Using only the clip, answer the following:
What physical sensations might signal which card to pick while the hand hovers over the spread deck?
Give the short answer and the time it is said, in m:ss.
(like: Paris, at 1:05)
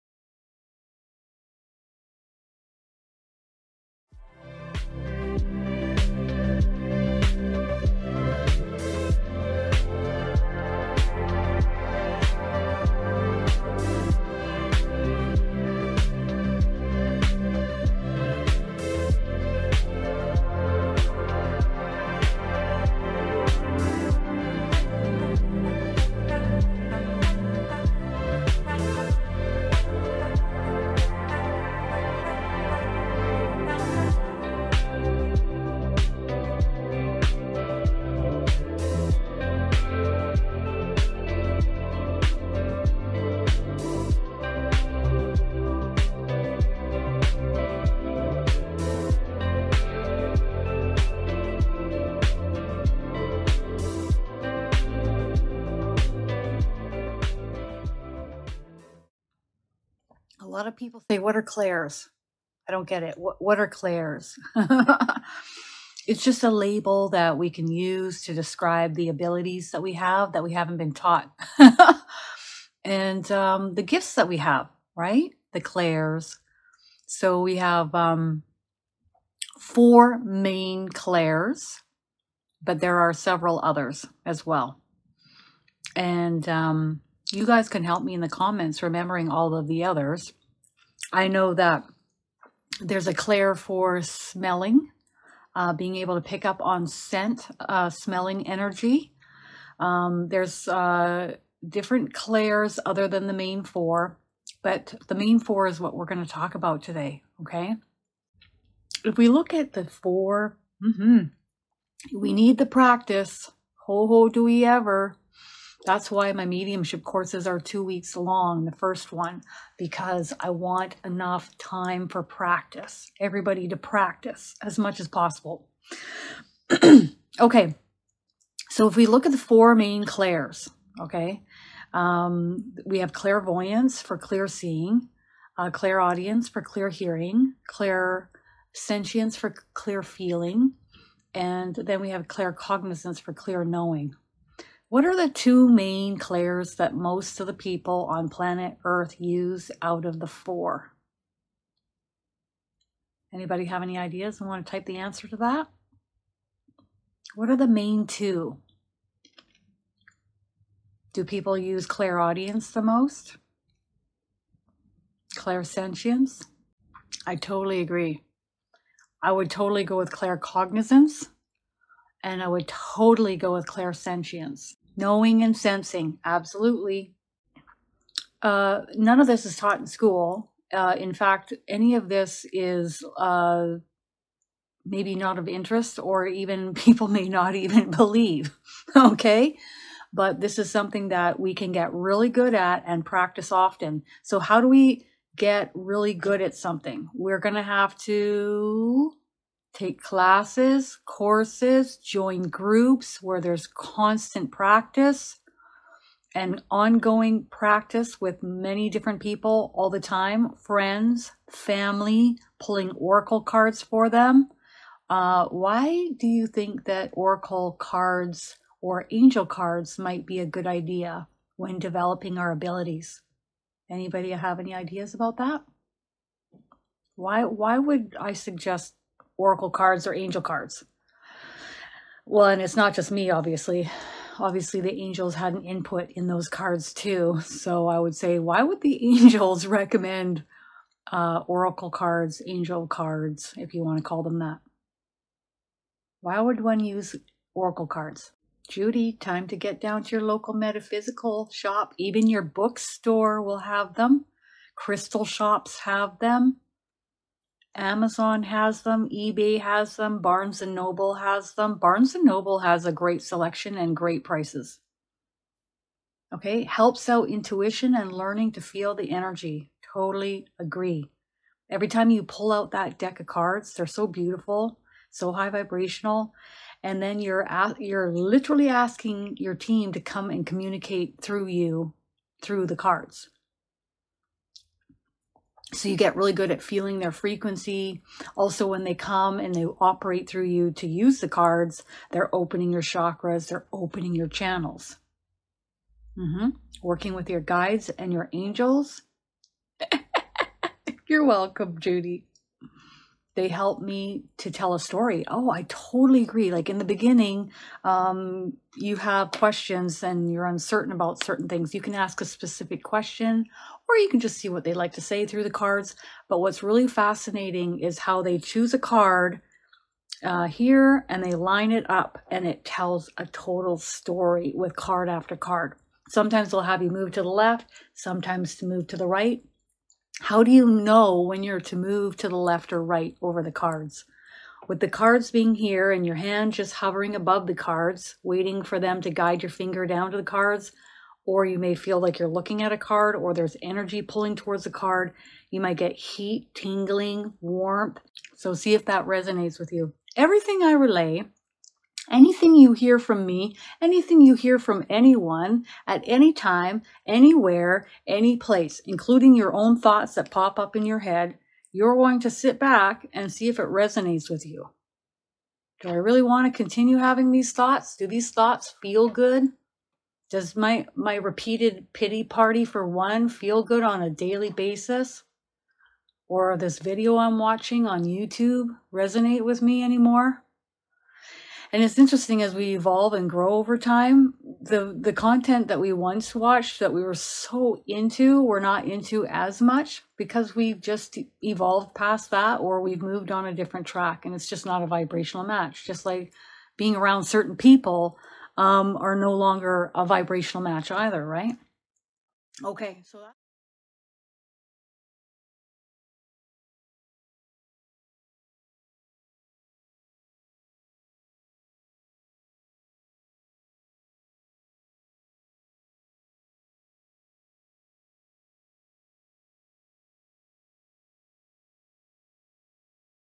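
heat, tingling, warmth, at 5:45.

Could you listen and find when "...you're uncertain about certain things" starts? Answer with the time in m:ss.
5:10.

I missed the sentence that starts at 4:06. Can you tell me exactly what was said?
Why would one use oracle cards?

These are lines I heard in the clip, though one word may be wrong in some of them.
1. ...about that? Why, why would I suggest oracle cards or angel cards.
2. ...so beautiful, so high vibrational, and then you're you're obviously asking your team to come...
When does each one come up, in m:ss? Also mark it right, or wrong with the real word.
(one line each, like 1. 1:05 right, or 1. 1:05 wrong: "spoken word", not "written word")
1. 3:45 right
2. 4:33 wrong: "literally", not "obviously".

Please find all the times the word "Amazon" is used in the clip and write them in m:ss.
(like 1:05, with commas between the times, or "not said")
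4:17.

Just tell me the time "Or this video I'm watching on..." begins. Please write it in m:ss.
6:16.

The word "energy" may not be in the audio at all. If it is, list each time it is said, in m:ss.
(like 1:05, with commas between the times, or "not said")
1:38, 4:29, 5:43.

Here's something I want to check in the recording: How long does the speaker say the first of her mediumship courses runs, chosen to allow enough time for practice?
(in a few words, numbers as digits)
2 weeks.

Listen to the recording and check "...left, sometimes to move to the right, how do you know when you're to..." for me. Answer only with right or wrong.
right.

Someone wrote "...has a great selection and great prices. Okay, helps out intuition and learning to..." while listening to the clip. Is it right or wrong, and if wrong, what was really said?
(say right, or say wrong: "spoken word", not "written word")
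right.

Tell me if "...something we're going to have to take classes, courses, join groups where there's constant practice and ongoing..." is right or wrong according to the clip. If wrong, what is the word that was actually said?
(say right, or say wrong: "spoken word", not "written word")
right.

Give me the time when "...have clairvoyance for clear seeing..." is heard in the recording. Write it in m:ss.
2:12.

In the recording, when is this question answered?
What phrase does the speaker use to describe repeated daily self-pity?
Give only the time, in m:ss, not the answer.
6:11.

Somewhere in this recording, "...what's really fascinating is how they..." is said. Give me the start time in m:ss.
5:16.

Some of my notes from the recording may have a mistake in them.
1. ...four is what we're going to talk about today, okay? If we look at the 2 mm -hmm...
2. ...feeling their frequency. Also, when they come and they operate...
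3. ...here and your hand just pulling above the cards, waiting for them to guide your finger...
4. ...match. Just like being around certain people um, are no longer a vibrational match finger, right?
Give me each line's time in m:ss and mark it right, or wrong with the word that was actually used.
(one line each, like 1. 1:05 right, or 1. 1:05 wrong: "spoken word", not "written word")
1. 1:45 wrong: "4", not "2"
2. 4:46 right
3. 5:35 wrong: "hovering", not "pulling"
4. 6:35 wrong: "either", not "finger".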